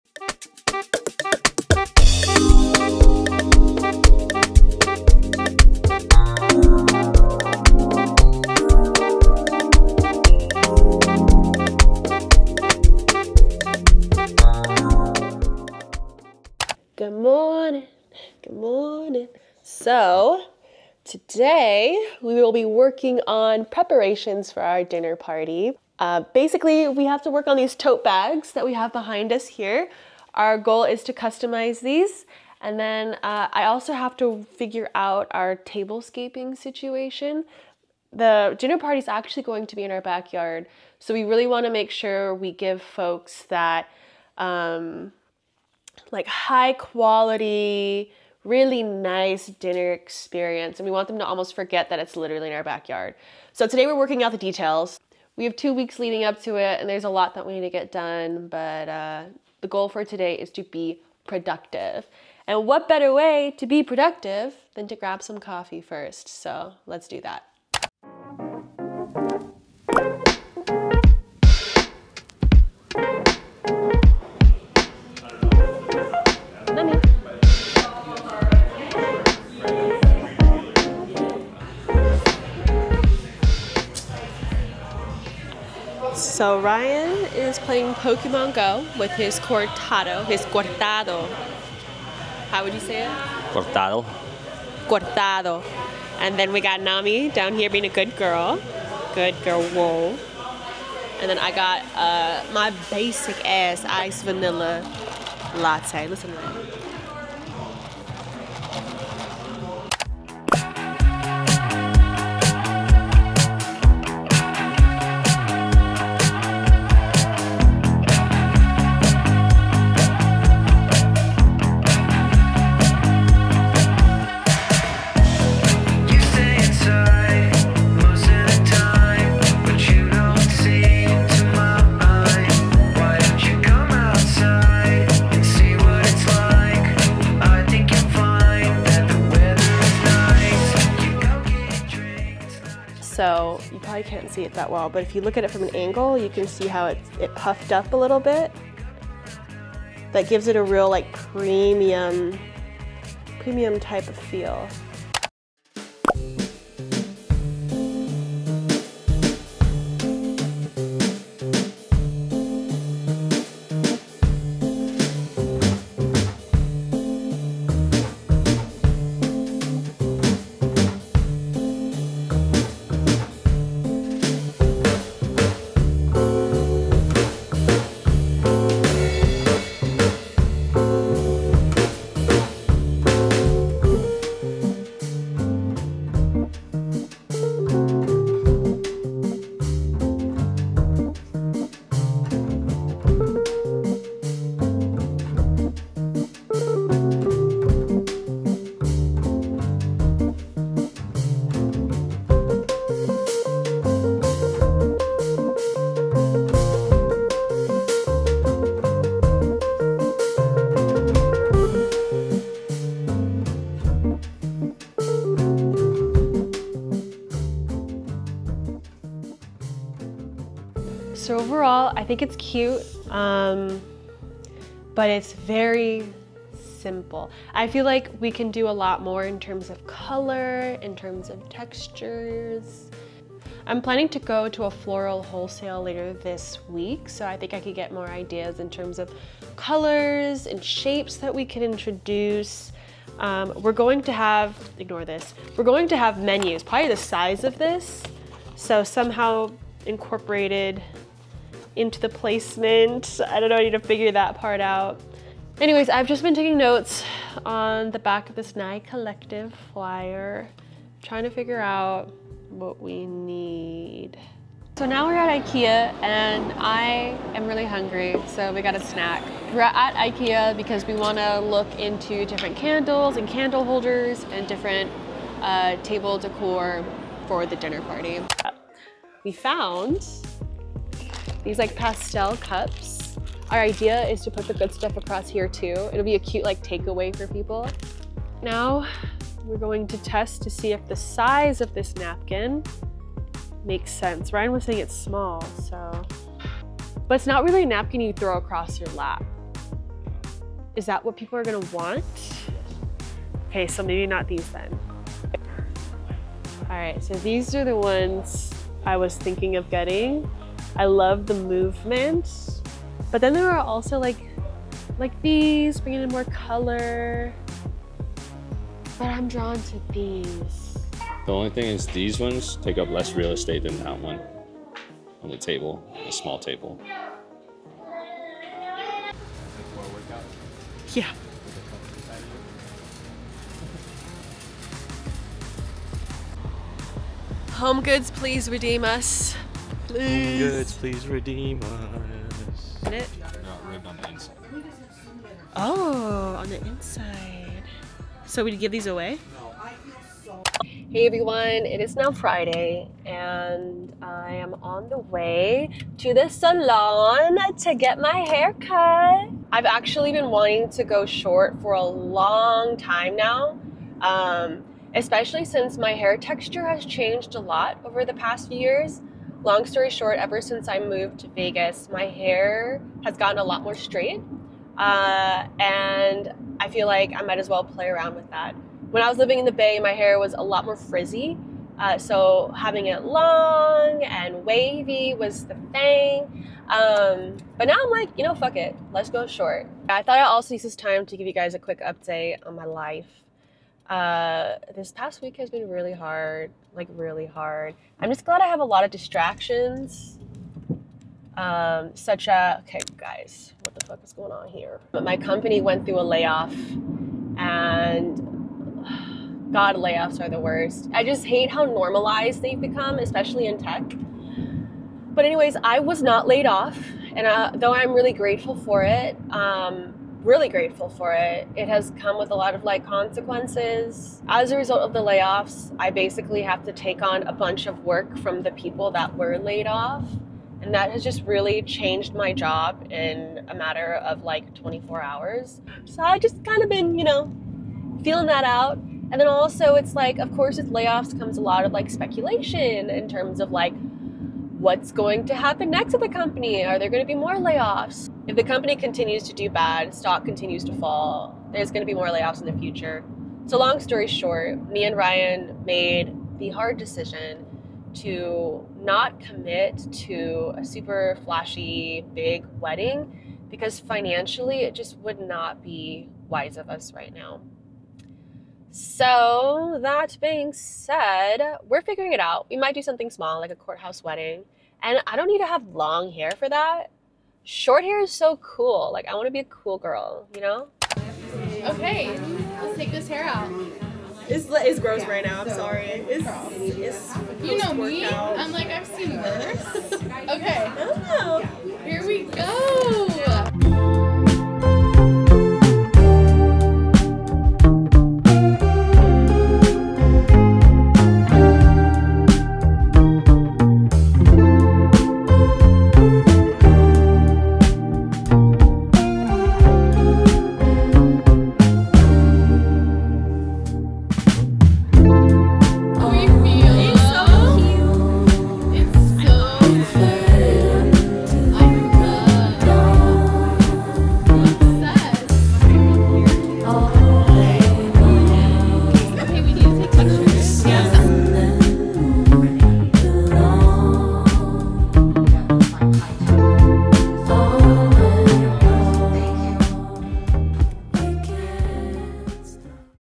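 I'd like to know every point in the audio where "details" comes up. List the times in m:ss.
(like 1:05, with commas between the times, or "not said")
0:54.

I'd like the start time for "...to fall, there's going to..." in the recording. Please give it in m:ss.
7:30.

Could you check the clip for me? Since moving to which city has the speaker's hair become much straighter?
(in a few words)
Vegas.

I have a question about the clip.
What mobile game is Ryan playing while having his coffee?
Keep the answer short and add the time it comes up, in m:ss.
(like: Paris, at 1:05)
Pokemon Go, at 1:27.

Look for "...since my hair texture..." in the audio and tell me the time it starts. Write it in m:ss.
6:05.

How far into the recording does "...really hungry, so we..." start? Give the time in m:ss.
4:27.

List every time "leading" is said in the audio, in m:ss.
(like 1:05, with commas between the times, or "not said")
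0:55.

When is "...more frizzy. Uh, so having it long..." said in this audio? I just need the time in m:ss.
6:20.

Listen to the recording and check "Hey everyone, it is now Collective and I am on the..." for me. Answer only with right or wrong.
wrong.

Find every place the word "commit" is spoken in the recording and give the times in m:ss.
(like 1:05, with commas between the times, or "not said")
7:39.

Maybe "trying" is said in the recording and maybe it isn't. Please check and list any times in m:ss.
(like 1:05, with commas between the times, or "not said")
4:21.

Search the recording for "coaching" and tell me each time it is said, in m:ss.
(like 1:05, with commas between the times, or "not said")
not said.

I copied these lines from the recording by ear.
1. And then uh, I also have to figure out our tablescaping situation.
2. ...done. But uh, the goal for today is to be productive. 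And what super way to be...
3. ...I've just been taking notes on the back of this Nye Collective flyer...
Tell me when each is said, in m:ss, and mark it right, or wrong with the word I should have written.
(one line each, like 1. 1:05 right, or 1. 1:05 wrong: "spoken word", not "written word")
1. 0:32 right
2. 0:57 wrong: "better", not "super"
3. 4:15 right.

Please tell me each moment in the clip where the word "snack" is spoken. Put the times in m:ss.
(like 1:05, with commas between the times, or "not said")
4:28.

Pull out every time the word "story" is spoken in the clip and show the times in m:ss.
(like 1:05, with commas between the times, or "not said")
6:09, 7:33.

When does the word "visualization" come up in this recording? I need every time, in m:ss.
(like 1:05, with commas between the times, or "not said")
not said.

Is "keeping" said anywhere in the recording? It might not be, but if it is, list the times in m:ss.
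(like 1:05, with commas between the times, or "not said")
not said.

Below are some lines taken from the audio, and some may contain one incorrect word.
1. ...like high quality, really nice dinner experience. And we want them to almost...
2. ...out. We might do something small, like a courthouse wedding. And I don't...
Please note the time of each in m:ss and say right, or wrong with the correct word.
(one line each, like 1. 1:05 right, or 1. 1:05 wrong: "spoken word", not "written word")
1. 0:46 right
2. 7:52 right.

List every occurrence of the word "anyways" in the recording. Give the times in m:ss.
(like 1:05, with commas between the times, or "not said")
4:15, 6:55.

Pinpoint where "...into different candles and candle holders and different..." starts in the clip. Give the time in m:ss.
4:31.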